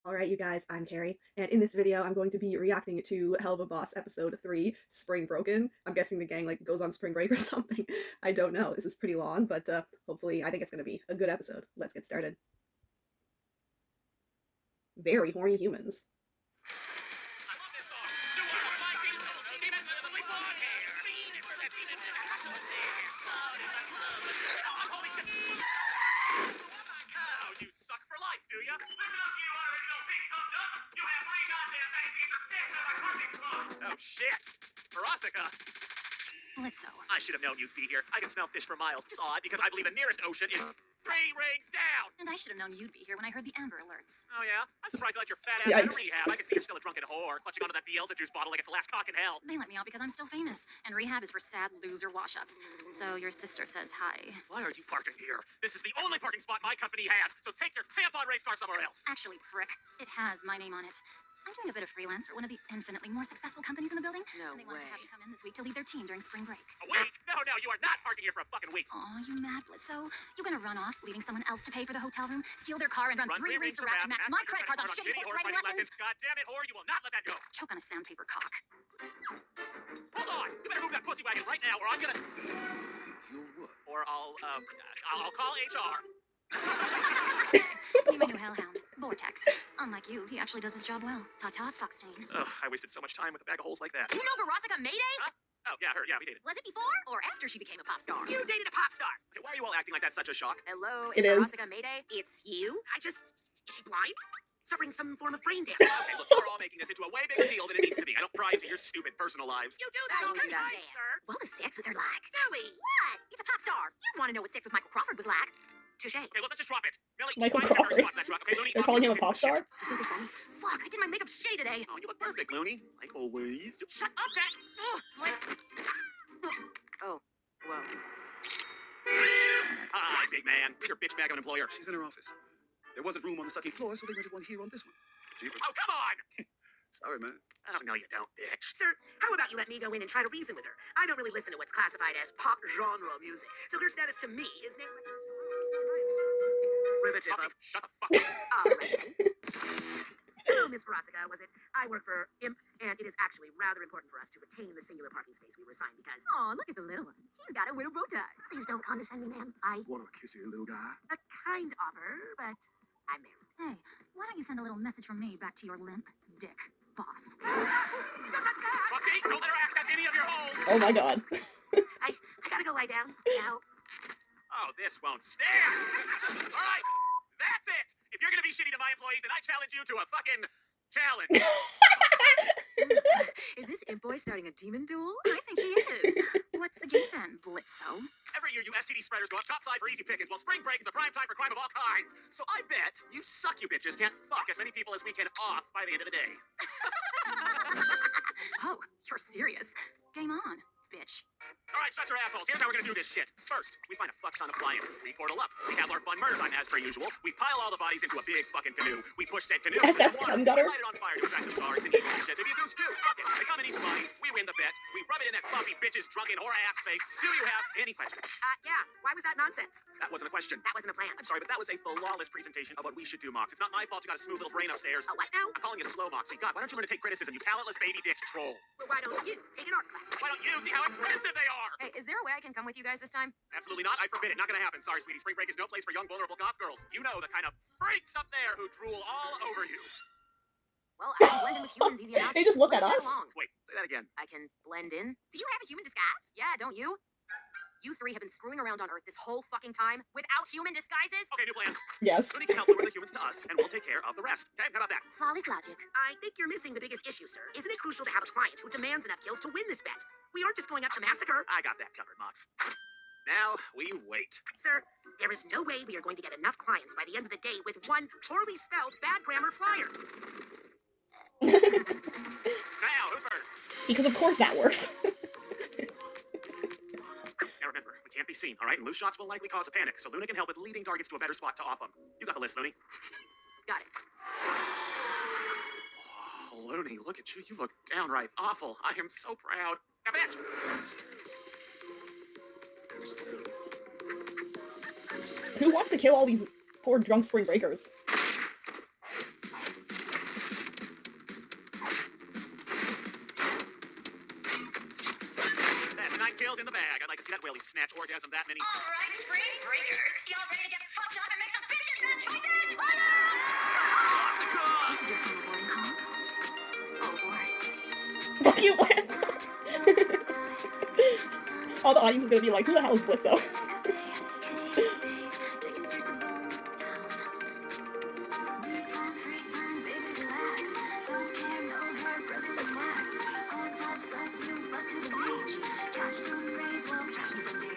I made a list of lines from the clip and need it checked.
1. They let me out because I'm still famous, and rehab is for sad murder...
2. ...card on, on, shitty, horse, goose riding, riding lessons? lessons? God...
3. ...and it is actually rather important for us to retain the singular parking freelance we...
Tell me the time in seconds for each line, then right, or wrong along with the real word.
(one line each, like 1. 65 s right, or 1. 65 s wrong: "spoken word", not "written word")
1. 49 s wrong: "loser", not "murder"
2. 74 s wrong: "horse", not "goose"
3. 152 s wrong: "space", not "freelance".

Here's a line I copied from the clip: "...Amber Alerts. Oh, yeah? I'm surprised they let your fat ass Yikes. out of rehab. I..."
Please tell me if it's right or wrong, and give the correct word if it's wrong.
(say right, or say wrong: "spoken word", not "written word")
right.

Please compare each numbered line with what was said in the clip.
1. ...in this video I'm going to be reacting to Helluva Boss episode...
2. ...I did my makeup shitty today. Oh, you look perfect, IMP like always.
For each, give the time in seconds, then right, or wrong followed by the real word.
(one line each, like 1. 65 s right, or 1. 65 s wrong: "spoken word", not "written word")
1. 1 s right
2. 120 s wrong: "Looney", not "IMP".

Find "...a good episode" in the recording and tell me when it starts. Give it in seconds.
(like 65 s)
11 s.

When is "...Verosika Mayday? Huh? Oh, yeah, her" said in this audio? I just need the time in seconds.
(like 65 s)
94 s.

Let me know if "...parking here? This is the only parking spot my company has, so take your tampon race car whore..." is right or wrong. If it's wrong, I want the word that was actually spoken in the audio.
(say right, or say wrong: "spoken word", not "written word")
wrong: "somewhere", not "whore".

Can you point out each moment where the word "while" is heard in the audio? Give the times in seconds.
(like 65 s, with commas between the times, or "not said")
190 s.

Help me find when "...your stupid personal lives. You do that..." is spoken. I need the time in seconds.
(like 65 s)
108 s.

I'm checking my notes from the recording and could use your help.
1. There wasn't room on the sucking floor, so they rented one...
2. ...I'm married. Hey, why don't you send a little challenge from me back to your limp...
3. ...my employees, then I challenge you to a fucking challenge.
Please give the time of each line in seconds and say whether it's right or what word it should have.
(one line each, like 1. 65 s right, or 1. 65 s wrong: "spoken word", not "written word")
1. 132 s right
2. 163 s wrong: "message", not "challenge"
3. 178 s right.